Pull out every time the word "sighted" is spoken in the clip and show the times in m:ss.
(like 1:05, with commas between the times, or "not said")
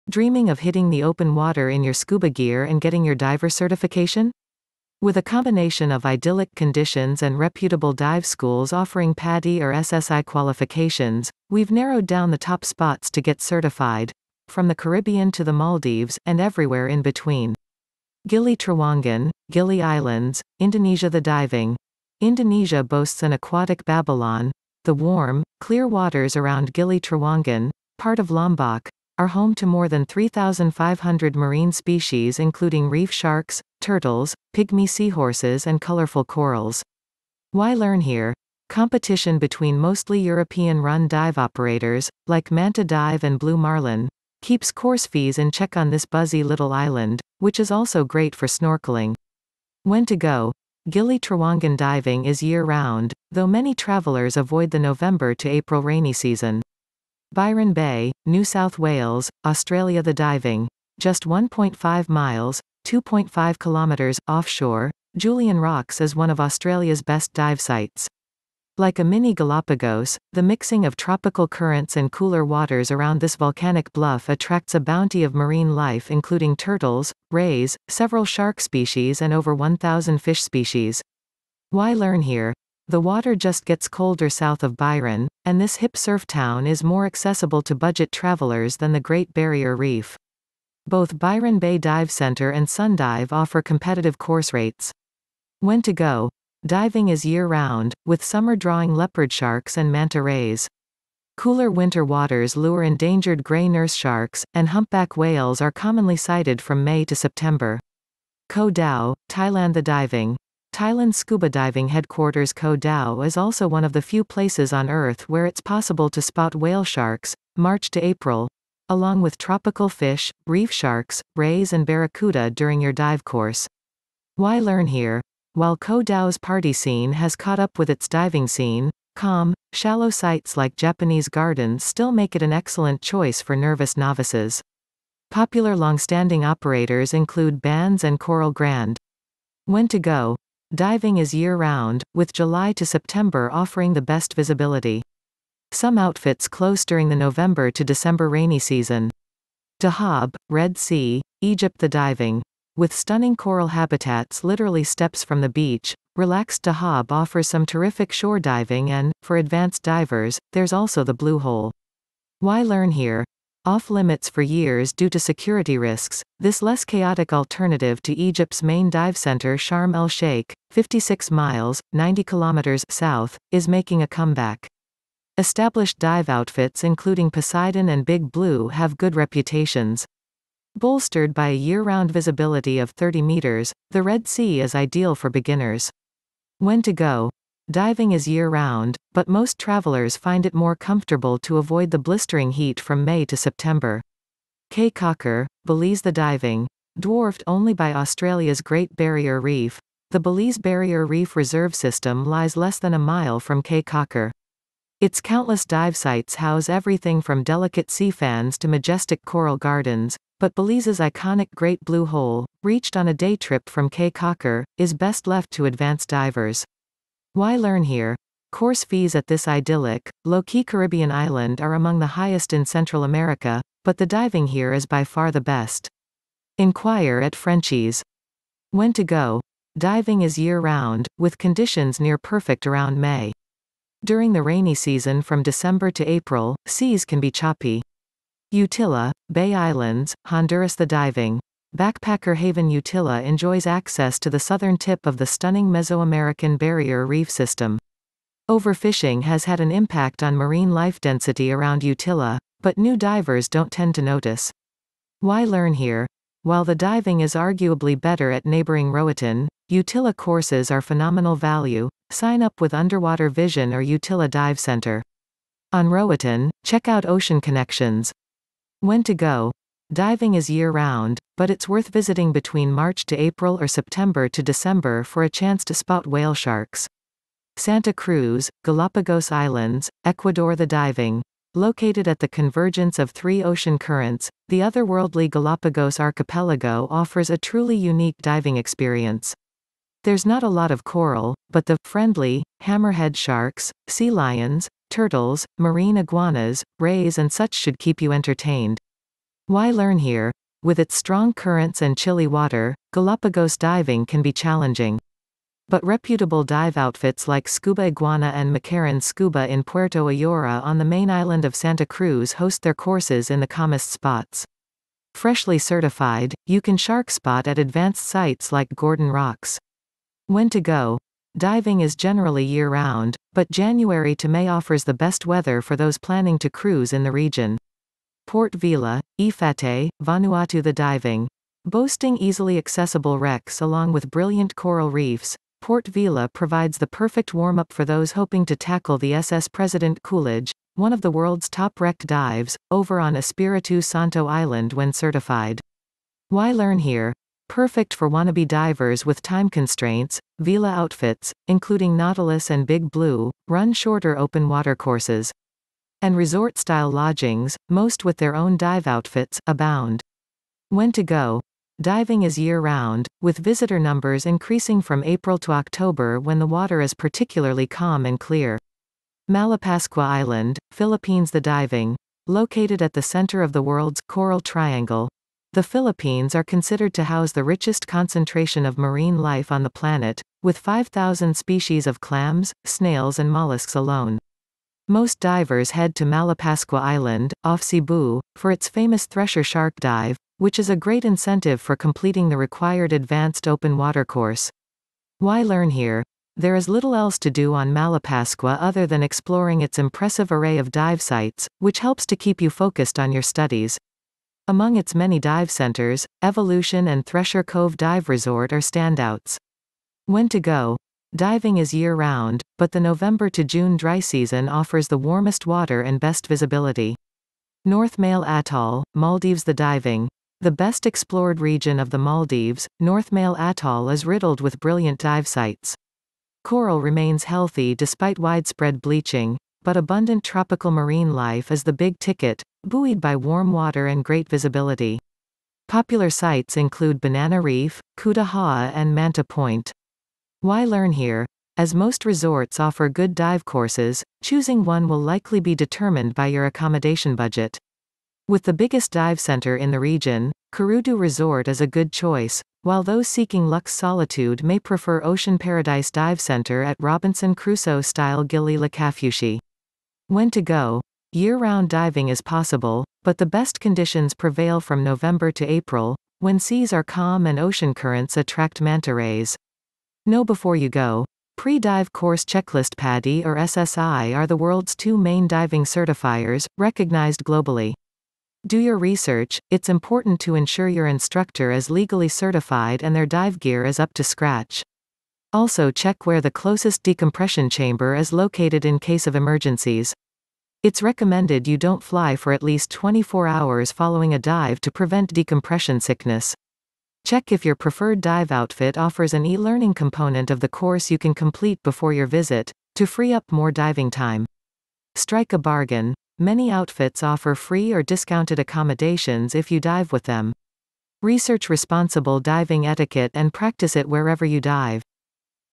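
1:46.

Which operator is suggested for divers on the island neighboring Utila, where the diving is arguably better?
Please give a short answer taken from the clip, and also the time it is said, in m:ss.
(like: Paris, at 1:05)
Ocean Connections, at 4:27.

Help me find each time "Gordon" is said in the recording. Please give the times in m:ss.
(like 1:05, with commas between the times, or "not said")
5:18.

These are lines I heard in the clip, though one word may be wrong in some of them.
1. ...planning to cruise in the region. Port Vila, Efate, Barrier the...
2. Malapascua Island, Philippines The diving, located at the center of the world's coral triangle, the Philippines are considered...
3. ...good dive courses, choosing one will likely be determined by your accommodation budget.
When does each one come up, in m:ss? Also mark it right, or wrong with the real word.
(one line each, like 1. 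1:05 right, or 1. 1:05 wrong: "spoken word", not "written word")
1. 5:25 wrong: "Vanuatu", not "Barrier"
2. 6:09 right
3. 7:22 right.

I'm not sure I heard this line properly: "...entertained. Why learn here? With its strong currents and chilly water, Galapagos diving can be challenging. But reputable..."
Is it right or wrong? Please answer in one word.
right.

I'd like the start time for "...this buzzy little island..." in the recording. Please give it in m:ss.
0:45.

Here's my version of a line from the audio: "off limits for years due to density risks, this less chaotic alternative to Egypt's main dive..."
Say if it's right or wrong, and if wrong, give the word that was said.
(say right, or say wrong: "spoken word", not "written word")
wrong: "security", not "density".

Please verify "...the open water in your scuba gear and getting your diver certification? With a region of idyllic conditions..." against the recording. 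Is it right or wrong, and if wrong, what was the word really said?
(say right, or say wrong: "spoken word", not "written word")
wrong: "combination", not "region".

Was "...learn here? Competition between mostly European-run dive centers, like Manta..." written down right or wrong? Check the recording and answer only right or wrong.
wrong.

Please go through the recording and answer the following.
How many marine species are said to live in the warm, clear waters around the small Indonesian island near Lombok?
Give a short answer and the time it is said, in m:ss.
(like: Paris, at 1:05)
3,500, at 0:30.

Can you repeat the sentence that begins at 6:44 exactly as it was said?
Among its many dive centers, Evolution and Thresher Cove Dive Resort are standouts.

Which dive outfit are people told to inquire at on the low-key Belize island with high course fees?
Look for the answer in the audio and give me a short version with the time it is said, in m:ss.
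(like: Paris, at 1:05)
Frenchies, at 3:47.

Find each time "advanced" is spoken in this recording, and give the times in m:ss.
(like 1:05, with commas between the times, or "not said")
2:39, 3:35, 5:17, 6:32.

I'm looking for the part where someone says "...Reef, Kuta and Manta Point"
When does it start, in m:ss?
7:17.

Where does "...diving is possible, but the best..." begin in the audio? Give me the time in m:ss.
7:41.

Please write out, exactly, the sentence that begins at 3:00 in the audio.
Bolstered by a year-round visibility of 30 meters, the Red Sea is ideal for beginners.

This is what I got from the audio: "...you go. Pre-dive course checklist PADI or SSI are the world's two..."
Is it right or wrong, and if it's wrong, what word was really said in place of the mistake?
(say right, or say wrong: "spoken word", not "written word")
right.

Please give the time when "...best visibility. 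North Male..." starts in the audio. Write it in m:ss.
6:55.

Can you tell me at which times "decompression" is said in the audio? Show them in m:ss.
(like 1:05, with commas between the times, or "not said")
8:06, 8:15.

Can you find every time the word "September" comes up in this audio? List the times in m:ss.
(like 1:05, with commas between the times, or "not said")
1:47, 2:22, 3:13, 4:33.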